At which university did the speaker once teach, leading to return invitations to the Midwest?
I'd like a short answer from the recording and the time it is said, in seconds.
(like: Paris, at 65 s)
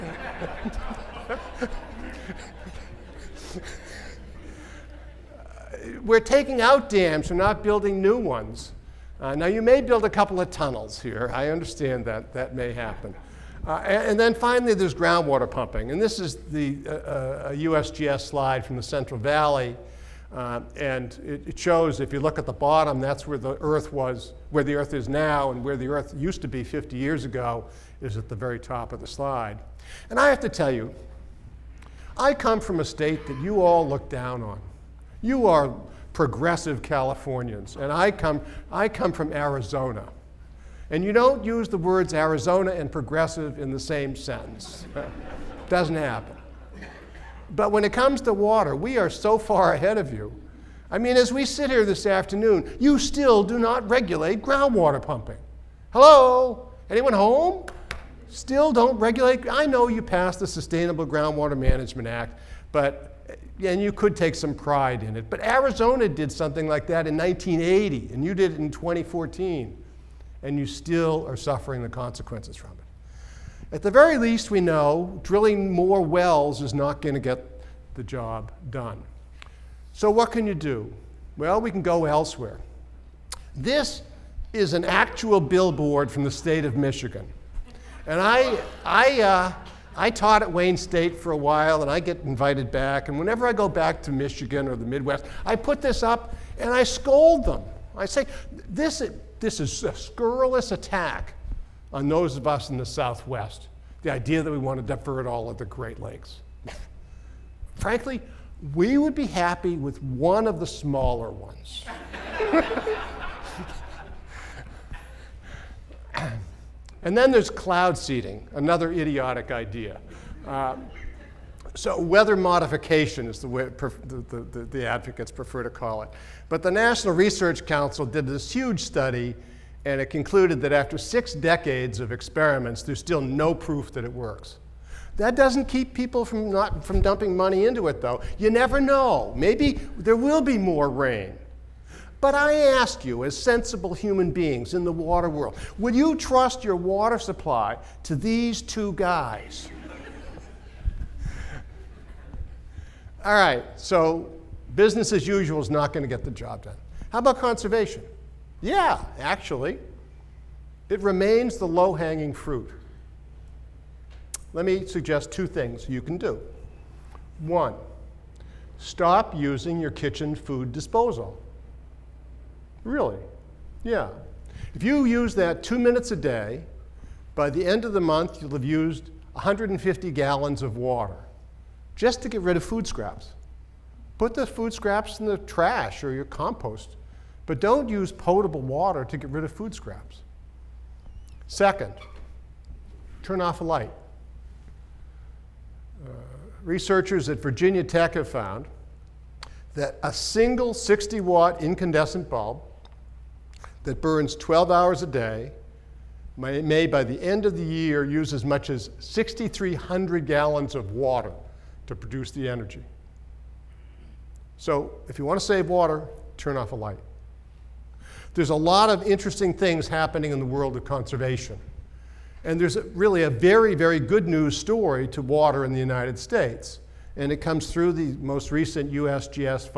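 Wayne State, at 90 s.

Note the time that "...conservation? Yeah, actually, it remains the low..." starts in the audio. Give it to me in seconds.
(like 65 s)
157 s.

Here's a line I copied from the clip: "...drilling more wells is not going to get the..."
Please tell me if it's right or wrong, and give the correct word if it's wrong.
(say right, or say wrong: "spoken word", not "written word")
right.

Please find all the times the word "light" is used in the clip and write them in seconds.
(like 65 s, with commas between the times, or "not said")
193 s, 216 s.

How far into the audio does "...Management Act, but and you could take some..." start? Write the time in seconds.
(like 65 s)
61 s.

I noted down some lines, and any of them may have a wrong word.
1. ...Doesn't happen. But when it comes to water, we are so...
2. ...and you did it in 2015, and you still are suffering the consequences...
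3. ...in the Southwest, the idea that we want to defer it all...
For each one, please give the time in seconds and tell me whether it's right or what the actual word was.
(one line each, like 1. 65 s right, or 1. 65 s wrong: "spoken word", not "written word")
1. 45 s right
2. 68 s wrong: "2014", not "2015"
3. 102 s right.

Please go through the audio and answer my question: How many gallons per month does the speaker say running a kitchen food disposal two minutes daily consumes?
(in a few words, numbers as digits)
150 gallons.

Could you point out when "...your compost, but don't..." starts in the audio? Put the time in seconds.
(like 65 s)
186 s.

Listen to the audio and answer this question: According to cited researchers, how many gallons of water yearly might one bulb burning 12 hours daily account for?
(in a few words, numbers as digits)
6,300 gallons.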